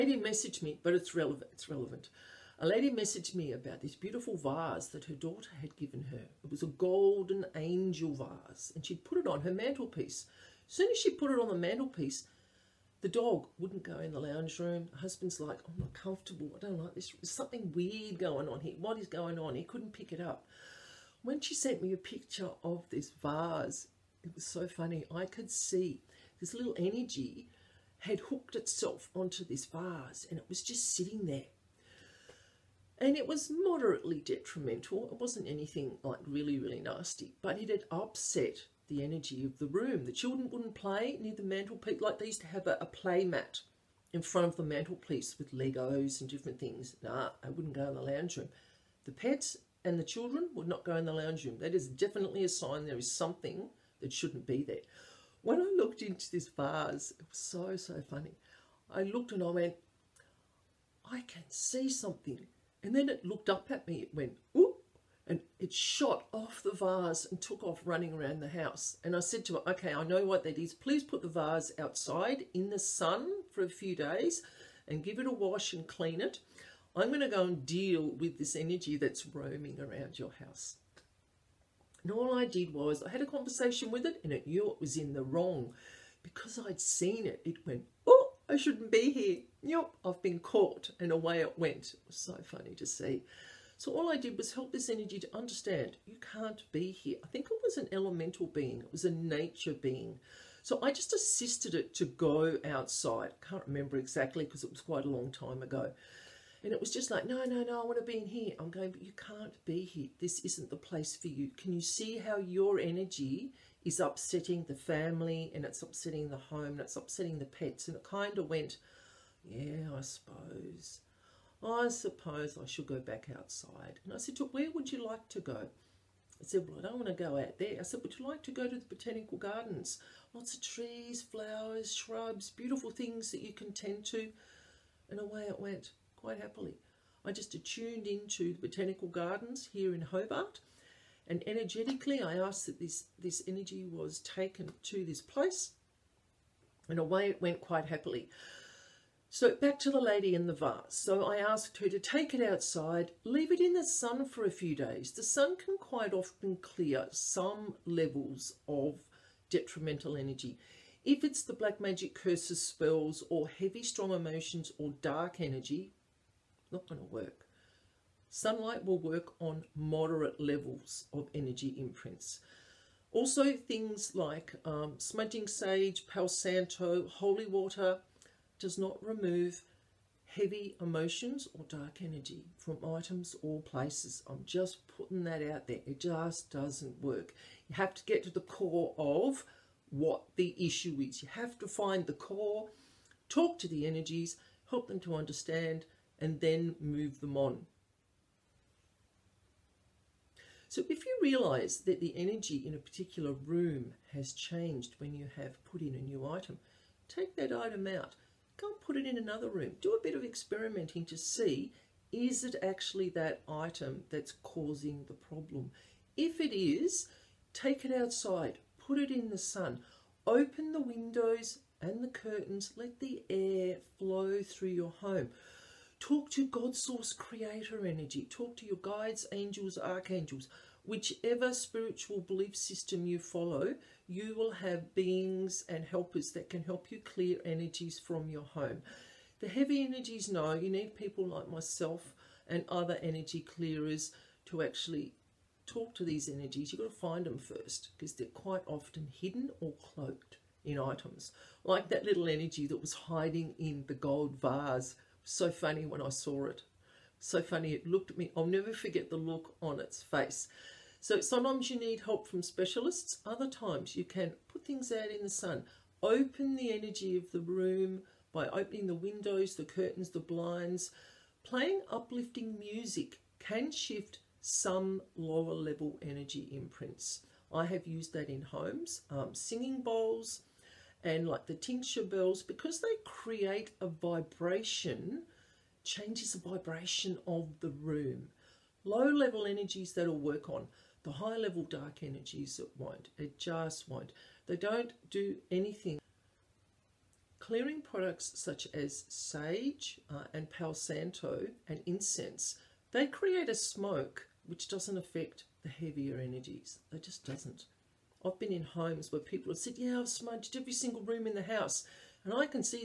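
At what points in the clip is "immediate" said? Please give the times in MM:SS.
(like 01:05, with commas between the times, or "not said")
not said.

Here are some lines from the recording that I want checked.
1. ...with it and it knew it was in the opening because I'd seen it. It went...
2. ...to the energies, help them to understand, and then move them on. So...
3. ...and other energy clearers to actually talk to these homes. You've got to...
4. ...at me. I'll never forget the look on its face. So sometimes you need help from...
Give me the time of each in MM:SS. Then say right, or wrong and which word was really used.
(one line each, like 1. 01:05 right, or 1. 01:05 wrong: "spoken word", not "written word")
1. 01:23 wrong: "wrong", not "opening"
2. 03:13 right
3. 04:02 wrong: "energies", not "homes"
4. 04:18 right.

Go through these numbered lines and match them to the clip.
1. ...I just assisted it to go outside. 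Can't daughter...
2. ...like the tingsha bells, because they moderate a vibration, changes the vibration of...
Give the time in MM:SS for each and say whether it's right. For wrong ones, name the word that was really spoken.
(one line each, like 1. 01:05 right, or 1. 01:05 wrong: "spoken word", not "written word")
1. 01:40 wrong: "remember", not "daughter"
2. 04:41 wrong: "create", not "moderate".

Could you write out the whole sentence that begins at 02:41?
If it's the black magic curses, spells, or heavy strong emotions or dark energy, not going to work.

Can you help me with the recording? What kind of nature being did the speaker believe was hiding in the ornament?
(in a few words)
Elemental being.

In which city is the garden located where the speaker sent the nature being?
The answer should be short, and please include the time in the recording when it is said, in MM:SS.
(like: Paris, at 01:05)
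Hobart, at 02:20.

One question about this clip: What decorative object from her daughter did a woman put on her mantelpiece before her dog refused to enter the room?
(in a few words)
Golden angel vase.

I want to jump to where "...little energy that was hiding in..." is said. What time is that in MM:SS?
04:12.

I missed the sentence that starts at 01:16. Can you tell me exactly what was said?
I'm going to go and deal with this energy that's roaming around your house.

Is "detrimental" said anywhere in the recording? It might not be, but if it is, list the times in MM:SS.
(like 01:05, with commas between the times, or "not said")
00:34, 02:39.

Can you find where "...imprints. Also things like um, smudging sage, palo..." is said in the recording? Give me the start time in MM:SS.
02:51.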